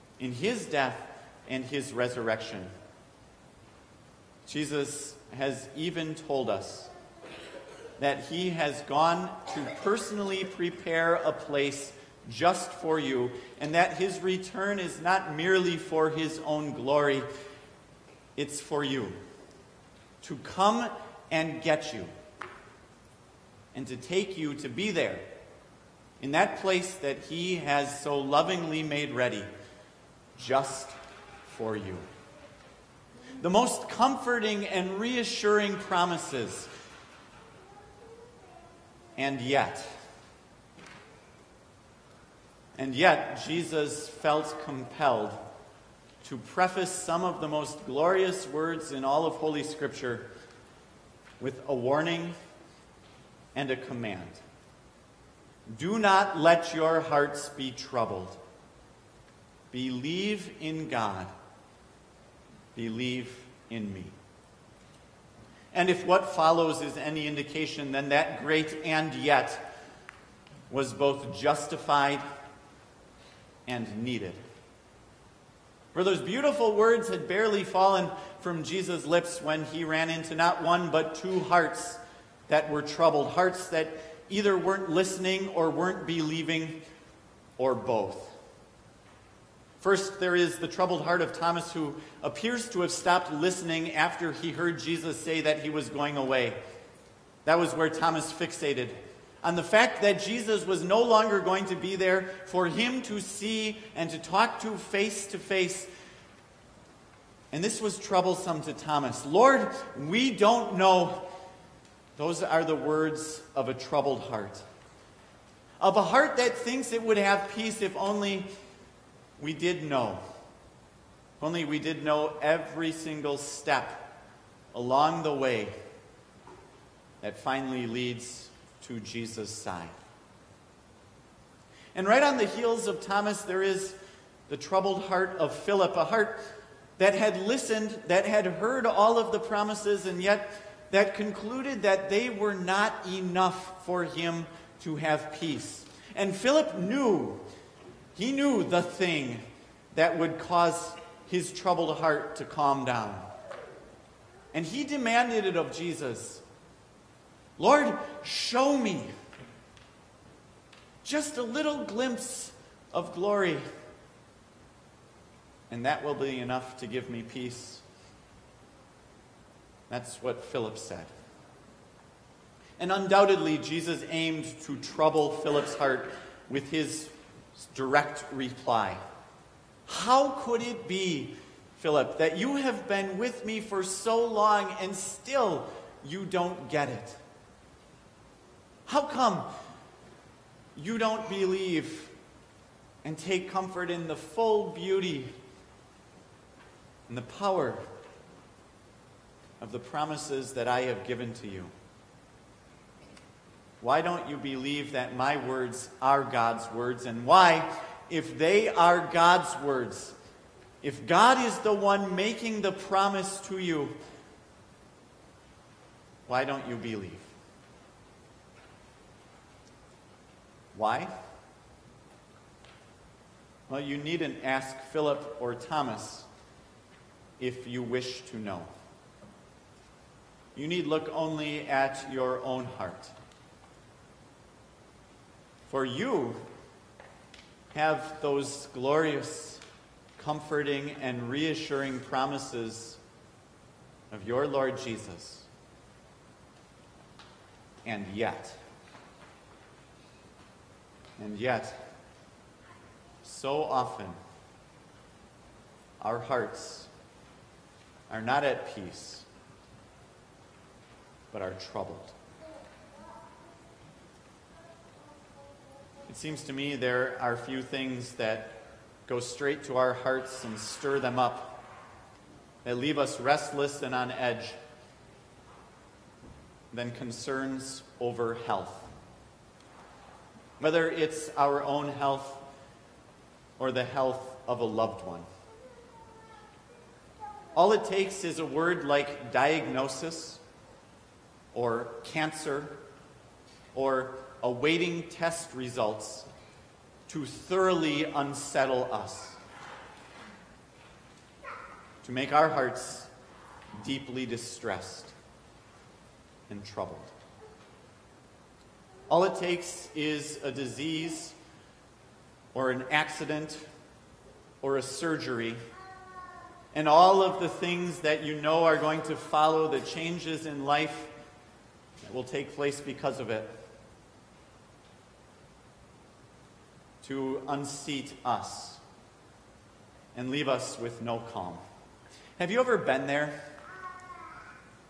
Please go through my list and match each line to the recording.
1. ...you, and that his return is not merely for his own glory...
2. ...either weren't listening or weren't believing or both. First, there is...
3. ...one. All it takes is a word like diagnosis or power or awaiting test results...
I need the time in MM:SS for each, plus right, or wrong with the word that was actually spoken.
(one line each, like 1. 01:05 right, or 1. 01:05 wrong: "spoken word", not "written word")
1. 00:12 right
2. 01:24 right
3. 04:45 wrong: "cancer", not "power".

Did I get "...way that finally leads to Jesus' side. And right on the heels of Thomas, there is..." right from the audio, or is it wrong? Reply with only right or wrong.
right.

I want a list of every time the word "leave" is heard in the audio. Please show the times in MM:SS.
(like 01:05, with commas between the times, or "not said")
04:32, 05:30.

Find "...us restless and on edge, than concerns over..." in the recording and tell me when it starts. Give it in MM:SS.
04:32.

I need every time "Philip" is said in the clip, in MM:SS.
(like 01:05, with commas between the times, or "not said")
02:15, 02:26, 02:50, 02:55, 03:01, 03:44.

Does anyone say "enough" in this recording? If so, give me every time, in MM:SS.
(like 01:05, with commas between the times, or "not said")
02:23, 02:46.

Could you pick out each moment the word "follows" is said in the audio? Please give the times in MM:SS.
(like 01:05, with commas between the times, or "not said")
01:06, 05:19.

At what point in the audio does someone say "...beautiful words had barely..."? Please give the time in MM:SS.
01:16.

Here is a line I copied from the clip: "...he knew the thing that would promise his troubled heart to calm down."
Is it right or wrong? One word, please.
wrong.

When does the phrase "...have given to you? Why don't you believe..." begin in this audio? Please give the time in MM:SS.
03:20.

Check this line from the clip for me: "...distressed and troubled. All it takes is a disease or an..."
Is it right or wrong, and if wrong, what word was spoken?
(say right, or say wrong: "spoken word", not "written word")
right.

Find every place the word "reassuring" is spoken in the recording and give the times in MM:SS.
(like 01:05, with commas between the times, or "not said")
00:34, 04:01.